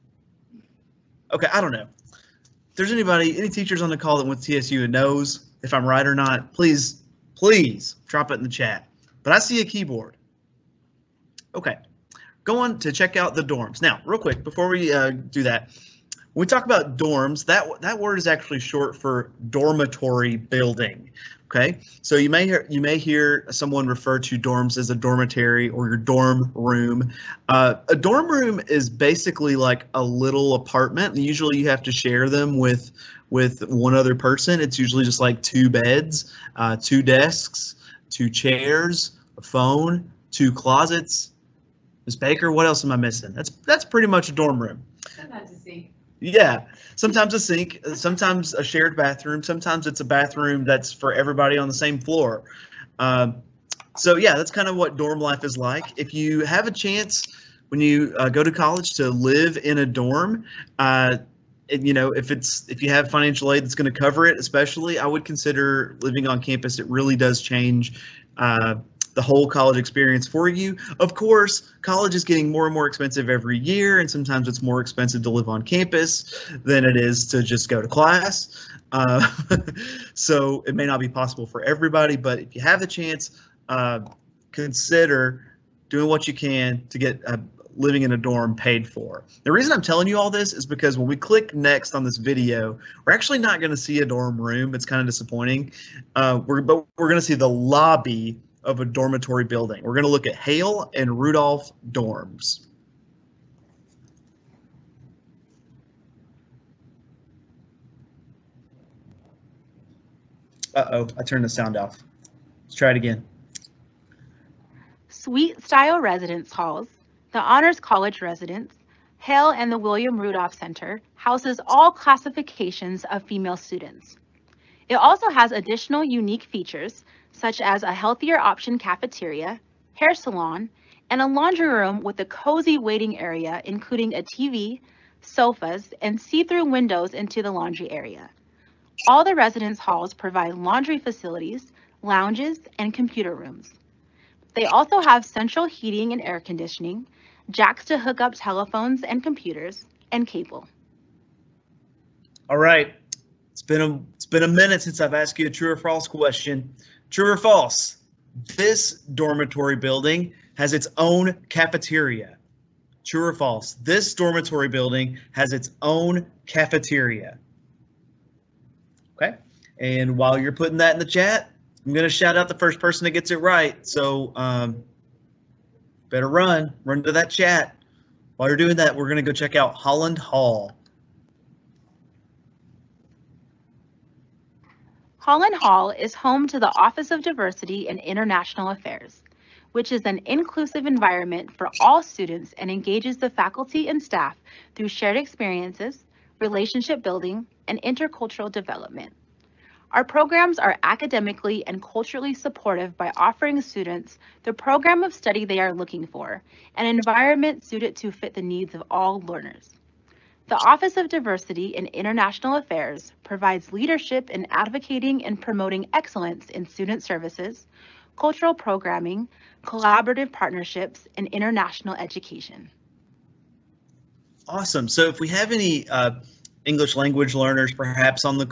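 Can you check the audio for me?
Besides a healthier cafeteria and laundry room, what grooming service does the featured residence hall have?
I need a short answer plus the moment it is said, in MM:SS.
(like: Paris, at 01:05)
hair salon, at 02:09.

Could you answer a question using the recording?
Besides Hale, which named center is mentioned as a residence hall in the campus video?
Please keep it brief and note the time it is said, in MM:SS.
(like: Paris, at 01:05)
Wilma Rudolph Center, at 01:59.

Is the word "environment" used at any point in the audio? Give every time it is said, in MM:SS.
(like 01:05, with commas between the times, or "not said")
03:10, 03:26.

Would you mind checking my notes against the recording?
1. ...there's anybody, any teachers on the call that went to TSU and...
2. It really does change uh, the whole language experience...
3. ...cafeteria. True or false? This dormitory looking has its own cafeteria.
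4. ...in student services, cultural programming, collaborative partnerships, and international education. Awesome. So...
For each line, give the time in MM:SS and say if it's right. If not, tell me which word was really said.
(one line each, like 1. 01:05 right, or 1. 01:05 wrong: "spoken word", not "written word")
1. 00:02 right
2. 01:06 wrong: "college", not "language"
3. 02:41 wrong: "building", not "looking"
4. 03:36 right.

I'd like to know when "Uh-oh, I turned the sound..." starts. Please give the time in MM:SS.
01:50.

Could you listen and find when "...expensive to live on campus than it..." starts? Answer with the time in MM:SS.
01:14.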